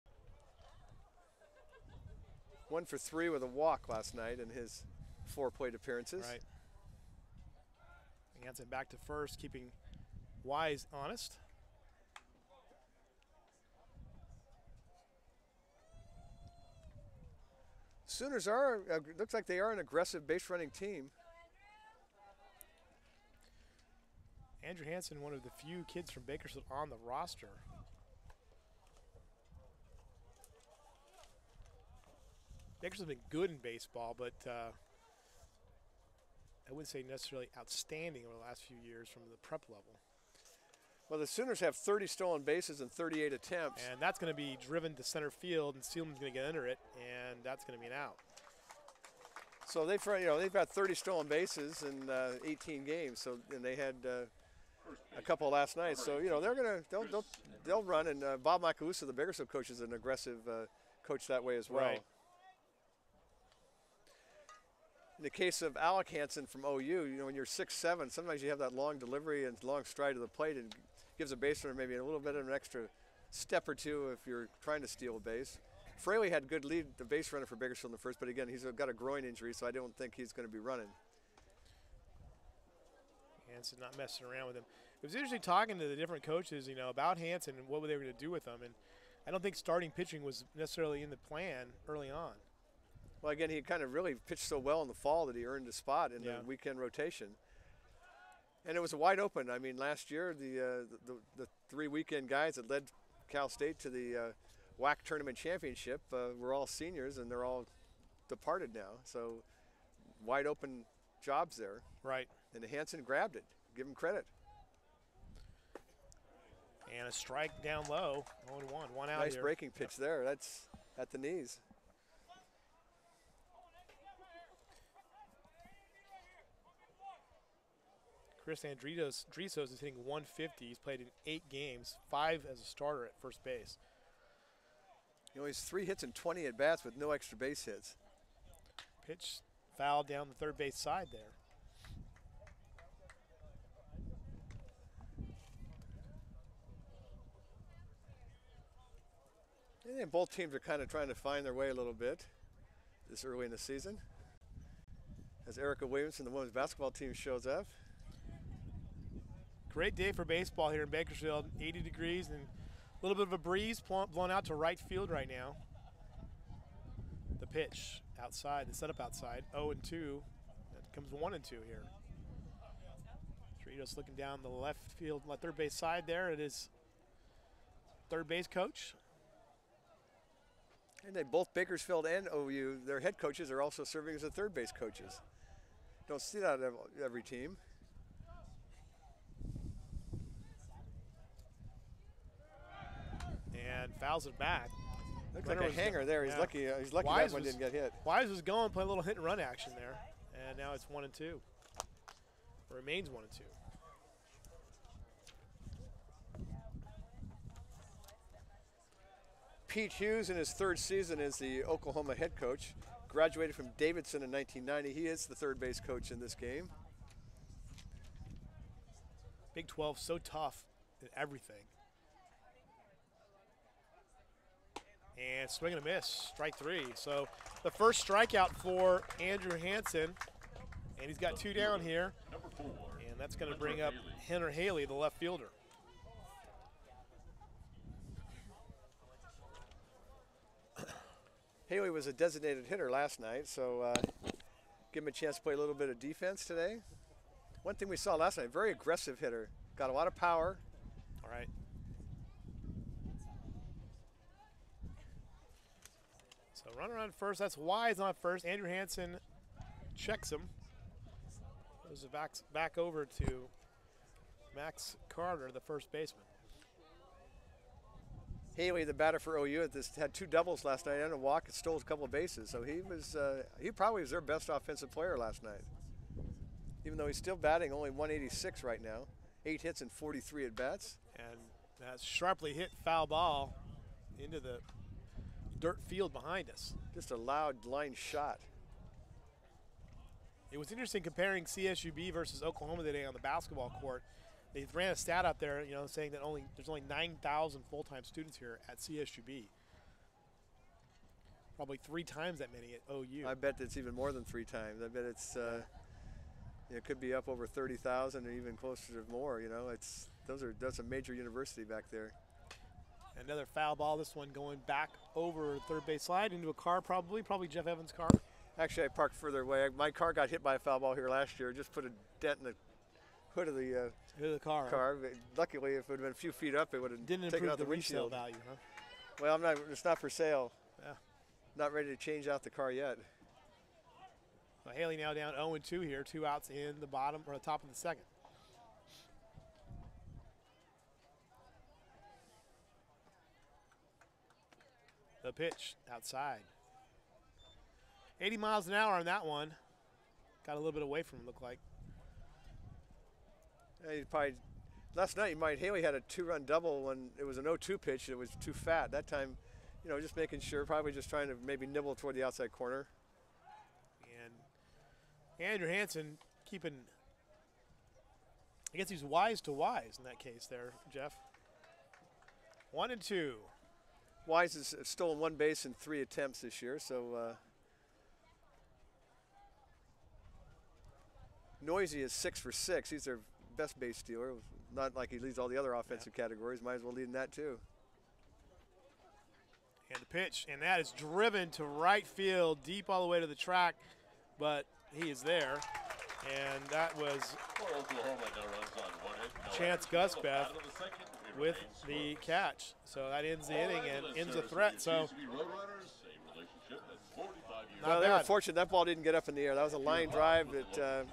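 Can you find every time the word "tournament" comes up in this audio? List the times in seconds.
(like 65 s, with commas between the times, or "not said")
105 s.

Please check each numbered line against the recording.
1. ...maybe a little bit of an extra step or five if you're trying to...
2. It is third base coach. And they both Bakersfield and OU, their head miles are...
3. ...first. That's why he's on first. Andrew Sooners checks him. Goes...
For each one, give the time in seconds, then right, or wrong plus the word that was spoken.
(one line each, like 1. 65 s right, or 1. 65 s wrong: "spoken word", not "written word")
1. 71 s wrong: "two", not "five"
2. 176 s wrong: "coaches", not "miles"
3. 257 s wrong: "Hanson", not "Sooners".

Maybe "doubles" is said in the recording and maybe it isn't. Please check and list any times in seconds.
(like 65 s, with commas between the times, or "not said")
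270 s, 356 s.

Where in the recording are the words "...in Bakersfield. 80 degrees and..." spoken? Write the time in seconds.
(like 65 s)
160 s.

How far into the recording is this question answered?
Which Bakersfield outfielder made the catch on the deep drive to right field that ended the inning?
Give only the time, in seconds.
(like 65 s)
399 s.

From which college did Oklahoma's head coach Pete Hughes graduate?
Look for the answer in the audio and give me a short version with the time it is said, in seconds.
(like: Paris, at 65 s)
Davidson, at 213 s.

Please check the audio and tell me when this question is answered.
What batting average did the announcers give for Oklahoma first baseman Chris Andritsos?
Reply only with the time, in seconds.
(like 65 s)
130 s.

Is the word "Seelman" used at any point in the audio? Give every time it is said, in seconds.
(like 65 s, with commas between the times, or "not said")
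45 s.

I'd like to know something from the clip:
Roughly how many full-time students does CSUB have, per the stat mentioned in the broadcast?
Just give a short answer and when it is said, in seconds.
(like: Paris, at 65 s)
9,000, at 296 s.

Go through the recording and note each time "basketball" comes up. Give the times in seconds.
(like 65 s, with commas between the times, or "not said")
156 s, 293 s.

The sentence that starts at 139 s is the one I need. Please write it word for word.
Pitch foul down the third base side there.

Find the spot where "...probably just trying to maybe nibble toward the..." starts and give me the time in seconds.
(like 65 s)
360 s.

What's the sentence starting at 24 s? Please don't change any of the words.
Andrew Hanson, one of the few kids from Bakersfield on the roster.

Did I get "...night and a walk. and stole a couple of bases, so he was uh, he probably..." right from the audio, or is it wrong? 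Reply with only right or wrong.
right.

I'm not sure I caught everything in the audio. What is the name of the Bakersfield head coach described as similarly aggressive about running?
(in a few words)
Bob Macalusa.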